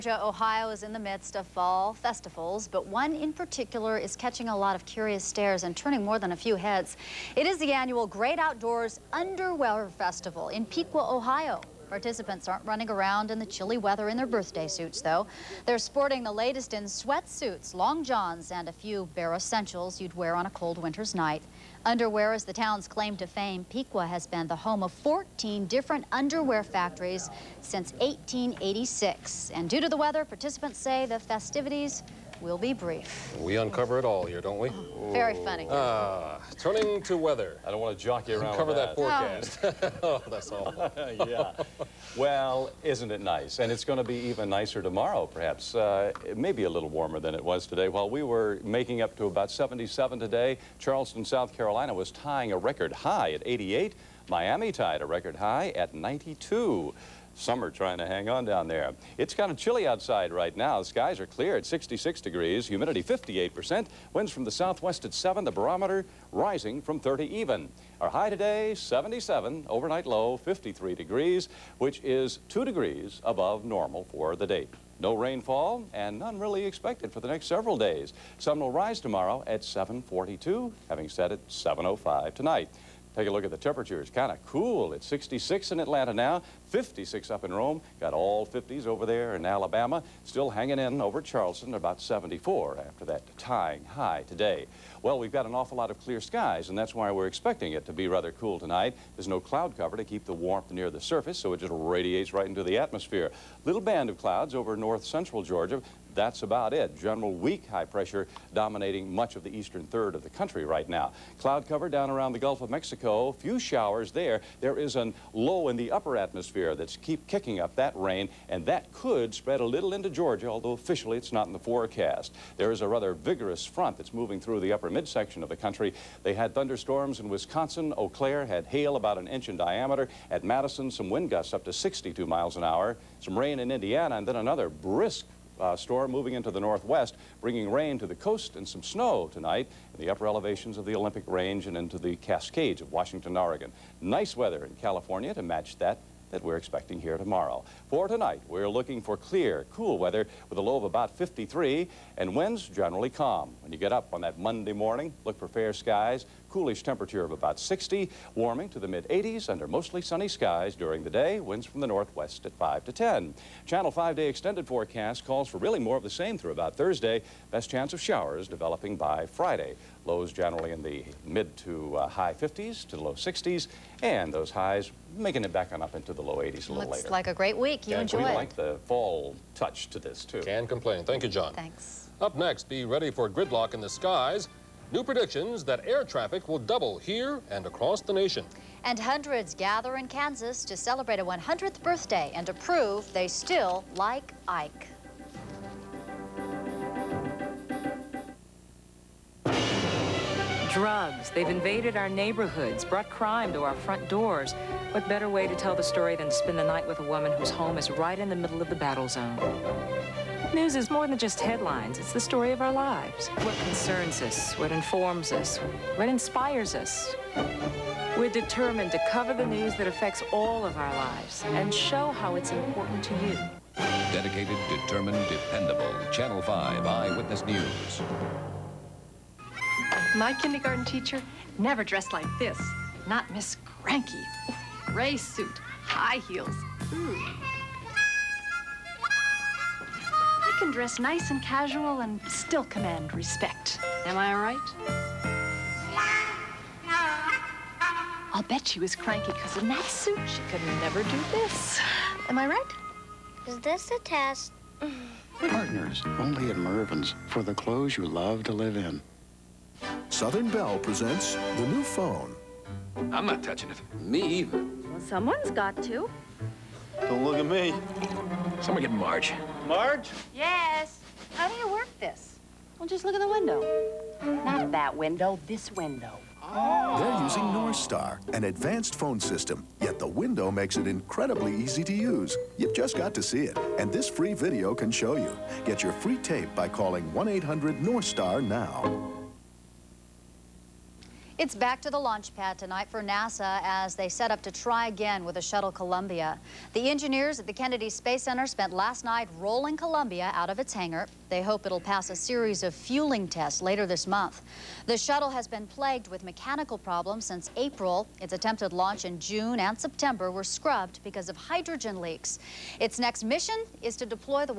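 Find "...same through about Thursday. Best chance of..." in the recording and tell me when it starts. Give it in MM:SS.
02:46.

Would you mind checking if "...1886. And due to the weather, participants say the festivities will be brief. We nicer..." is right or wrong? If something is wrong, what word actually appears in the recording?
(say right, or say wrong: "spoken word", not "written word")
wrong: "uncover", not "nicer".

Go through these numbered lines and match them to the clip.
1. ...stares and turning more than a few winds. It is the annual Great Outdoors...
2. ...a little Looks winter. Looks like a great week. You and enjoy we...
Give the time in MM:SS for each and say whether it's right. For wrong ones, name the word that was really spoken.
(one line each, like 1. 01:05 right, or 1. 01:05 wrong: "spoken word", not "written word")
1. 00:05 wrong: "heads", not "winds"
2. 02:56 wrong: "later", not "winter".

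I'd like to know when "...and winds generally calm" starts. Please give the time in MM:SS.
02:32.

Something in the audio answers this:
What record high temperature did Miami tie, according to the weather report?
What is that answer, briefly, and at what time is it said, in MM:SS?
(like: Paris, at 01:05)
92, at 00:55.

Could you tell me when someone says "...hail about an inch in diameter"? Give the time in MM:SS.
02:08.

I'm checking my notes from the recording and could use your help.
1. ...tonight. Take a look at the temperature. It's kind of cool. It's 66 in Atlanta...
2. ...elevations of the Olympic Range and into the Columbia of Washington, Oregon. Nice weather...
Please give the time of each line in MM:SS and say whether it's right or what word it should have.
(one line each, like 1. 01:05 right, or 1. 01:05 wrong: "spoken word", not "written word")
1. 01:22 right
2. 02:20 wrong: "Cascades", not "Columbia".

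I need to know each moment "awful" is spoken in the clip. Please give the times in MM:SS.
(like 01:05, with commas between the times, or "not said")
01:35.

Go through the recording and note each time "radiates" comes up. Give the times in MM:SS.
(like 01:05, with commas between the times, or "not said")
01:41.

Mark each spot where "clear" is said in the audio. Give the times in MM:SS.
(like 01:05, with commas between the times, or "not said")
01:01, 01:35, 02:29.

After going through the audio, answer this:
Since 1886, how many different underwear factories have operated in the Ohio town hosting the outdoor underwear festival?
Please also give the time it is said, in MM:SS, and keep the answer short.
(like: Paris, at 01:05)
14, at 00:24.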